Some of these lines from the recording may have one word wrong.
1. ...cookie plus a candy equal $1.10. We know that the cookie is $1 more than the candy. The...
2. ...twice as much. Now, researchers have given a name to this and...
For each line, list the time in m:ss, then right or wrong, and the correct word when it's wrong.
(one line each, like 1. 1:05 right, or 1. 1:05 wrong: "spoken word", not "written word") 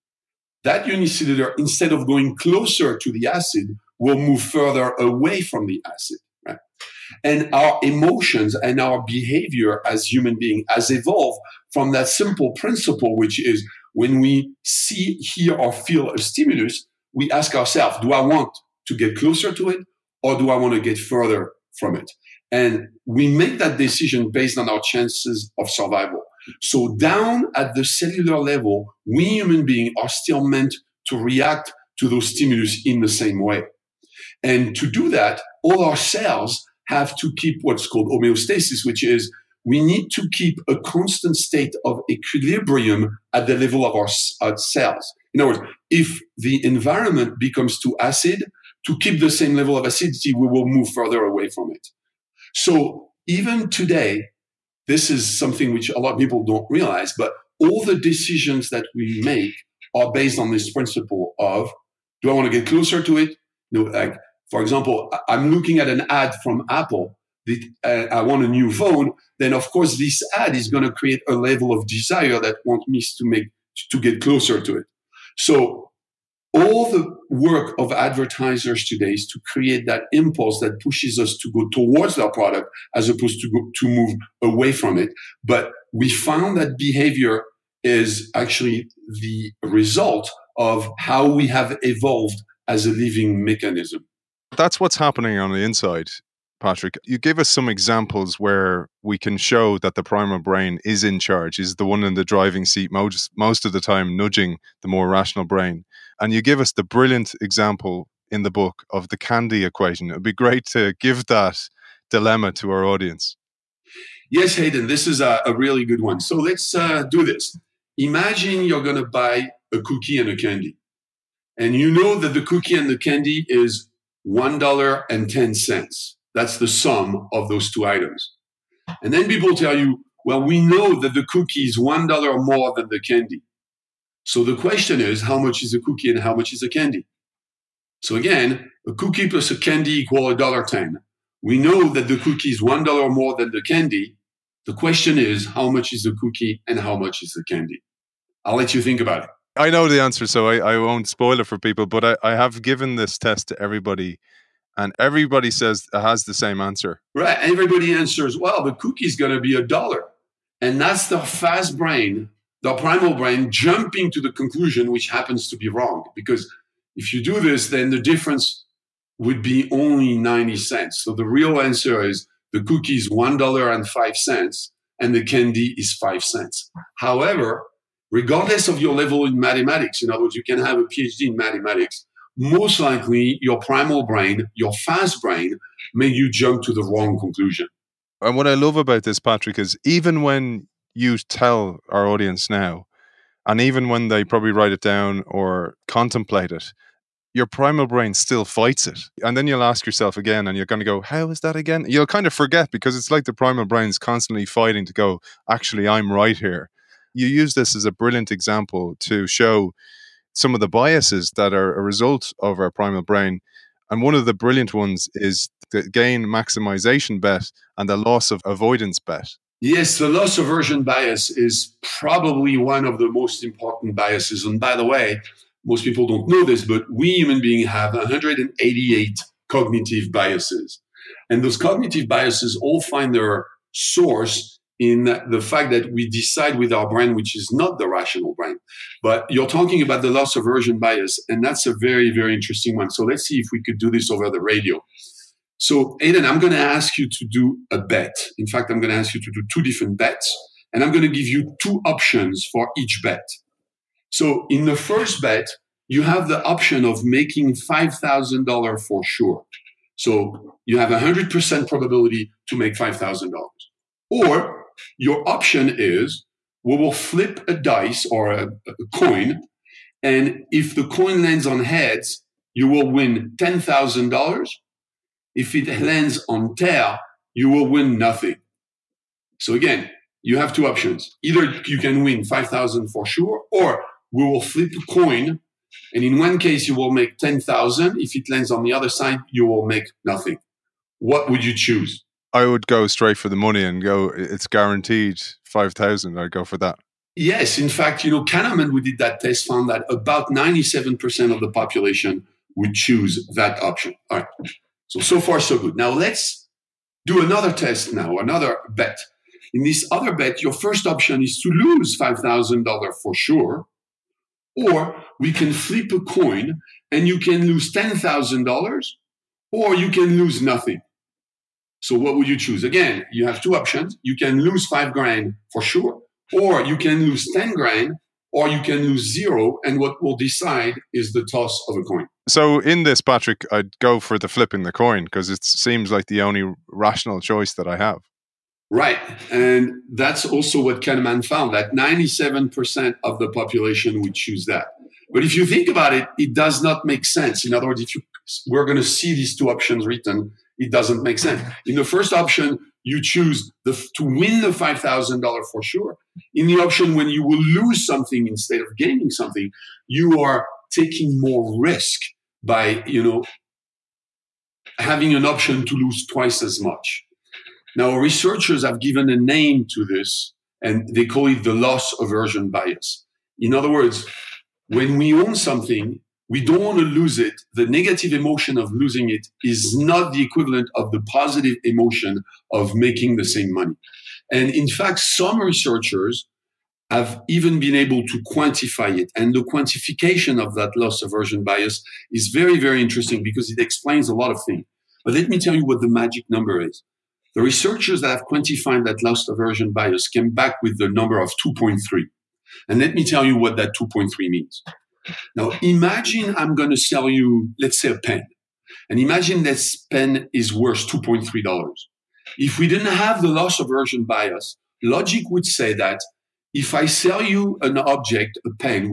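1. 2:18 right
2. 6:06 right.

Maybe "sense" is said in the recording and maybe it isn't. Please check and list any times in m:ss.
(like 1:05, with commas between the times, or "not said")
5:47, 5:51.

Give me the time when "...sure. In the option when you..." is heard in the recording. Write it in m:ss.
5:55.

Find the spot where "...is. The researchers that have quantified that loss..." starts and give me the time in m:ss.
6:36.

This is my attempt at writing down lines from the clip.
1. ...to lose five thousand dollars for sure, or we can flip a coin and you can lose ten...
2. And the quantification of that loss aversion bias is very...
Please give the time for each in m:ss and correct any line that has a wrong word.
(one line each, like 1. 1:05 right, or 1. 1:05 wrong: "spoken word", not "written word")
1. 5:11 right
2. 6:29 right.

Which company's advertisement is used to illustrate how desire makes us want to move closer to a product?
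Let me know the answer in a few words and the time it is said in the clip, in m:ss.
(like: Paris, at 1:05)
Apple, at 1:06.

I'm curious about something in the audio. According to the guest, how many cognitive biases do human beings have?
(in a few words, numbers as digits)
188.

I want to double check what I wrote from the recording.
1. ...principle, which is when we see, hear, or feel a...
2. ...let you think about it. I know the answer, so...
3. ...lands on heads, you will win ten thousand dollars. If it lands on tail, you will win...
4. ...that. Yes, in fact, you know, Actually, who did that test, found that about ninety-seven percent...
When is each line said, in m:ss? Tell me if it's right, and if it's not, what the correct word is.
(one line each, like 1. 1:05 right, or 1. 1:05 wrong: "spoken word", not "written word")
1. 0:12 right
2. 2:28 right
3. 4:31 right
4. 4:56 wrong: "Kahneman", not "Actually".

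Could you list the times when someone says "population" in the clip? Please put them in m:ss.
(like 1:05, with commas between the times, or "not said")
5:01, 5:43.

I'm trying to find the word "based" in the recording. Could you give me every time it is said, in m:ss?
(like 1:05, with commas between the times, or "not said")
0:24, 1:00.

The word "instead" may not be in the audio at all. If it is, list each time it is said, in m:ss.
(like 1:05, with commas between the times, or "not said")
0:01, 5:58.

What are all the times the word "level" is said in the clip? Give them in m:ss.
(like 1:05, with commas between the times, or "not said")
0:28, 0:43, 0:49, 1:11, 2:58.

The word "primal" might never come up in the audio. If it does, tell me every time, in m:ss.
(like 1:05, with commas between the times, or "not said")
1:40, 2:42, 3:03, 3:17, 3:23, 3:32.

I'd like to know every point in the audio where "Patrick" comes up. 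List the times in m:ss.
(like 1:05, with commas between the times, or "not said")
1:36, 3:09, 5:32.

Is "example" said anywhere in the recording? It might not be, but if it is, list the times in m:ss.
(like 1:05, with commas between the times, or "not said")
1:04, 1:37, 1:47, 3:28.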